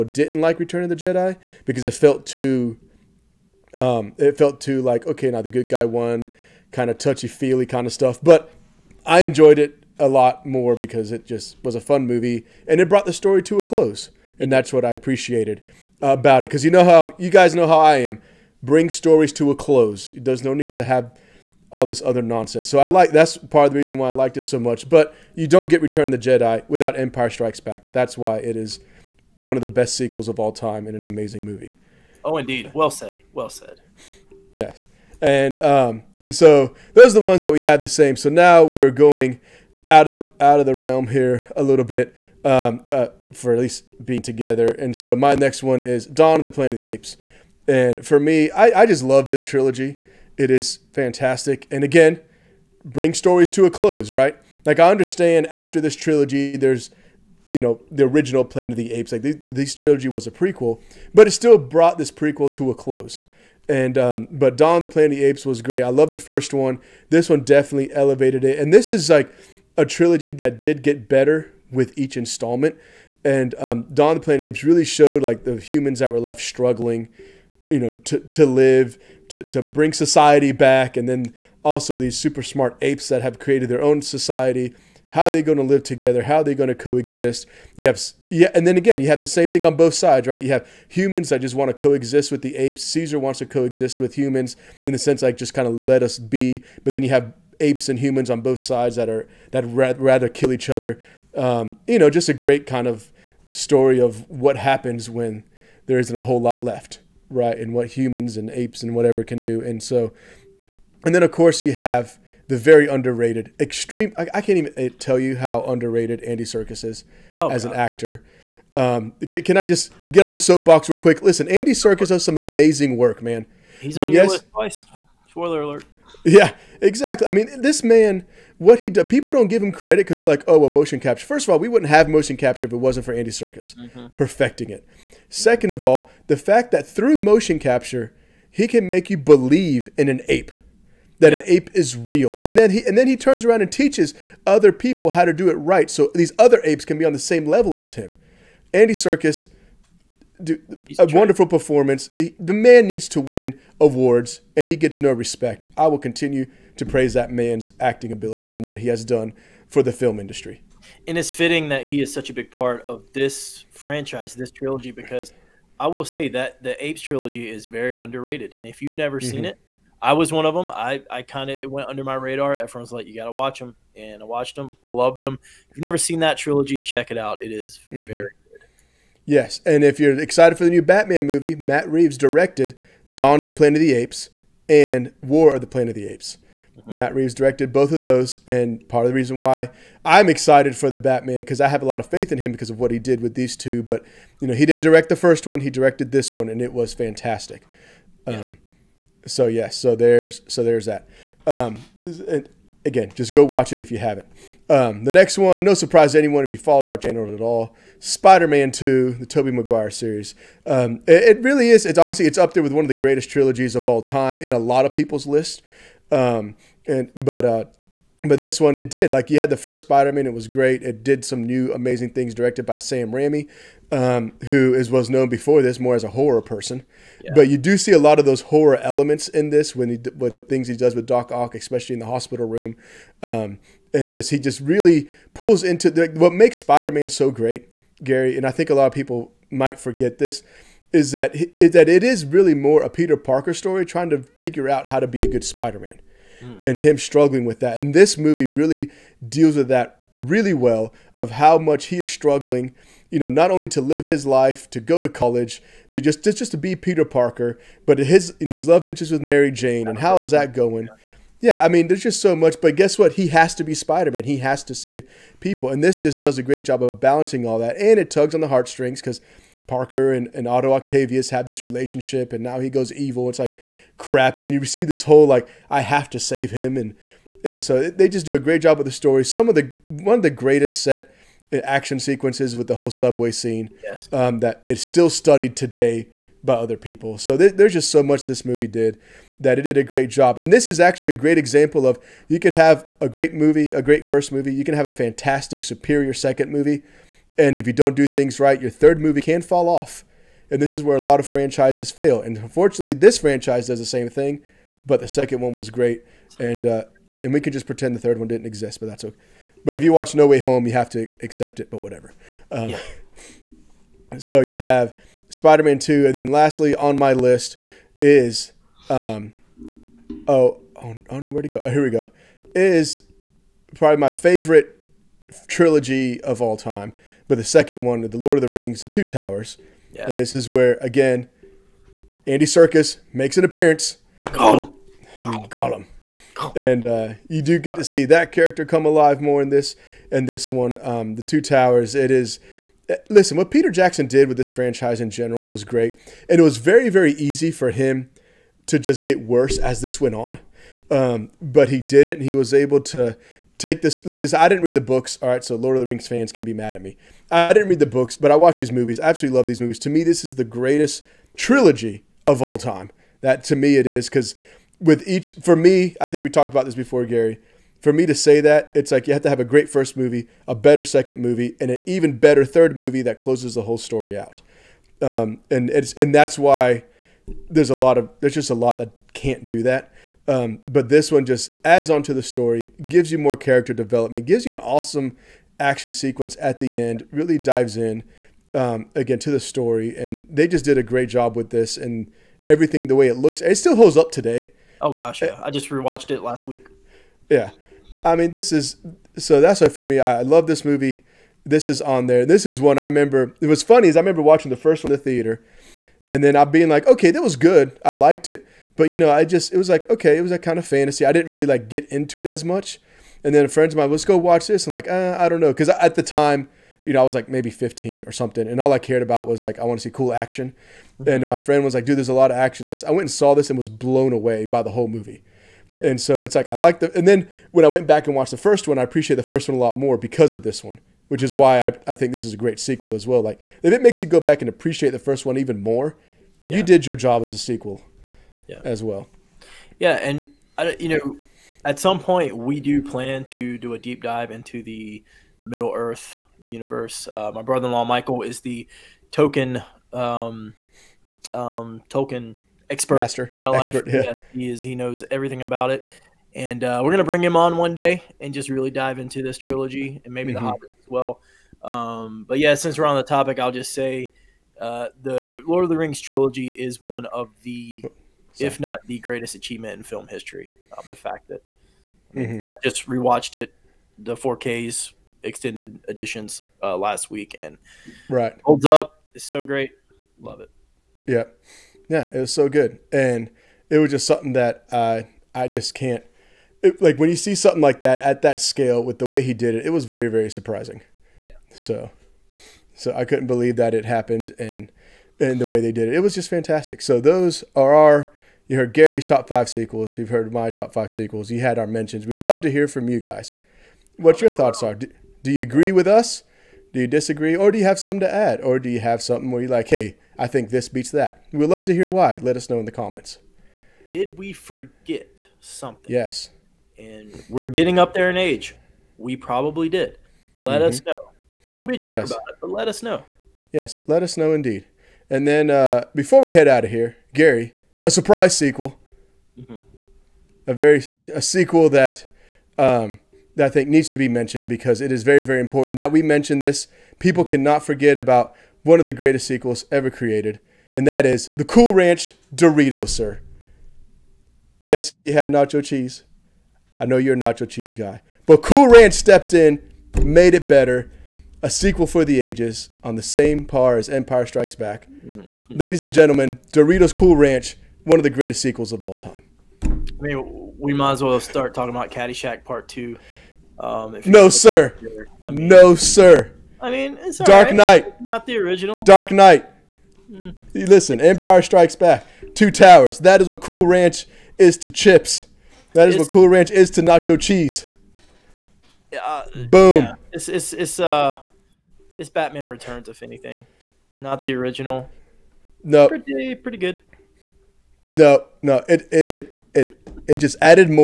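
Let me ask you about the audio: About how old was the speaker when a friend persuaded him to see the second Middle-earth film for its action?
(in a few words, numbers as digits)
15.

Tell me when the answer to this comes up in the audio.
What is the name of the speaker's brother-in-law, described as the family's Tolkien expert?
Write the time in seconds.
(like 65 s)
447 s.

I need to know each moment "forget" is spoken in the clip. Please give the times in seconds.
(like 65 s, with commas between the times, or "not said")
239 s, 514 s, 537 s.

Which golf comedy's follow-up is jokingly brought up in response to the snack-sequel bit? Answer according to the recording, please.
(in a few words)
Caddyshack Part Two.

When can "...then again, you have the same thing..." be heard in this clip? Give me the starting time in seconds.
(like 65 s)
88 s.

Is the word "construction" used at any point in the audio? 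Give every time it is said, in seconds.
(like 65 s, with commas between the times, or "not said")
not said.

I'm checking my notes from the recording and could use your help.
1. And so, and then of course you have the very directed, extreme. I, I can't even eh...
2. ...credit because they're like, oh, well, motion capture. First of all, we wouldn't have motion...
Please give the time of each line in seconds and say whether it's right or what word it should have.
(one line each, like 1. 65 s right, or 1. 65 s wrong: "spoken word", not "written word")
1. 109 s wrong: "underrated", not "directed"
2. 129 s right.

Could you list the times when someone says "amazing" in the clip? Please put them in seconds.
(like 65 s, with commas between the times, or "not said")
31 s, 122 s, 221 s.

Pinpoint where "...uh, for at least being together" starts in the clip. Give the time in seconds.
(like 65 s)
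42 s.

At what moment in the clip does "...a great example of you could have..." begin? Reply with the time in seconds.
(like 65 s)
291 s.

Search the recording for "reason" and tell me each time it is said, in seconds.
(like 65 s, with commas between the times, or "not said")
23 s, 189 s.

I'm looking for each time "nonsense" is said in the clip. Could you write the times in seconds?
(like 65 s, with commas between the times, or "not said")
22 s.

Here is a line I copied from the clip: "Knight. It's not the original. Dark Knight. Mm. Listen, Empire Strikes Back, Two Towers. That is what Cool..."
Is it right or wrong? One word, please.
right.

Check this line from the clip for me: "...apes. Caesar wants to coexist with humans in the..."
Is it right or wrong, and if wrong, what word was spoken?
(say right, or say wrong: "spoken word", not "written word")
right.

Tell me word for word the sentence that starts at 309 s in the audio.
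But if you watch No Way Home, you have to accept it, but whatever.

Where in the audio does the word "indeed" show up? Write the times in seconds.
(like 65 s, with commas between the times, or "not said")
32 s, 524 s.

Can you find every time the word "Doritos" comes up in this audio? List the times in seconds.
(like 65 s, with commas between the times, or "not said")
542 s, 556 s.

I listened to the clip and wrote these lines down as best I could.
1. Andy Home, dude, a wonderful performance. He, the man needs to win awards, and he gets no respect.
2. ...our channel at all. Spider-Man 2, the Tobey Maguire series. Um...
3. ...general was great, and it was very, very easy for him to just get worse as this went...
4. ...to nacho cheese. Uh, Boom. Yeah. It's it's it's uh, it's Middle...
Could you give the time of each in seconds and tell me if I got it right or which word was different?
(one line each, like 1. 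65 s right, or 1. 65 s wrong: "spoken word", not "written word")
1. 148 s wrong: "Serkis", not "Home"
2. 206 s right
3. 345 s right
4. 576 s wrong: "Batman", not "Middle".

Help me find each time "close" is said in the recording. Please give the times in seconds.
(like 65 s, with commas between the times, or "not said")
13 s, 19 s, 53 s, 62 s, 373 s.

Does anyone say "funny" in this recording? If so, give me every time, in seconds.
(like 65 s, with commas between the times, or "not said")
403 s.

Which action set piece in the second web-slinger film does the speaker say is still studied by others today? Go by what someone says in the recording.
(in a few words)
subway scene.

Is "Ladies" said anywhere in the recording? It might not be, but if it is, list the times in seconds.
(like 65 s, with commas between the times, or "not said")
555 s.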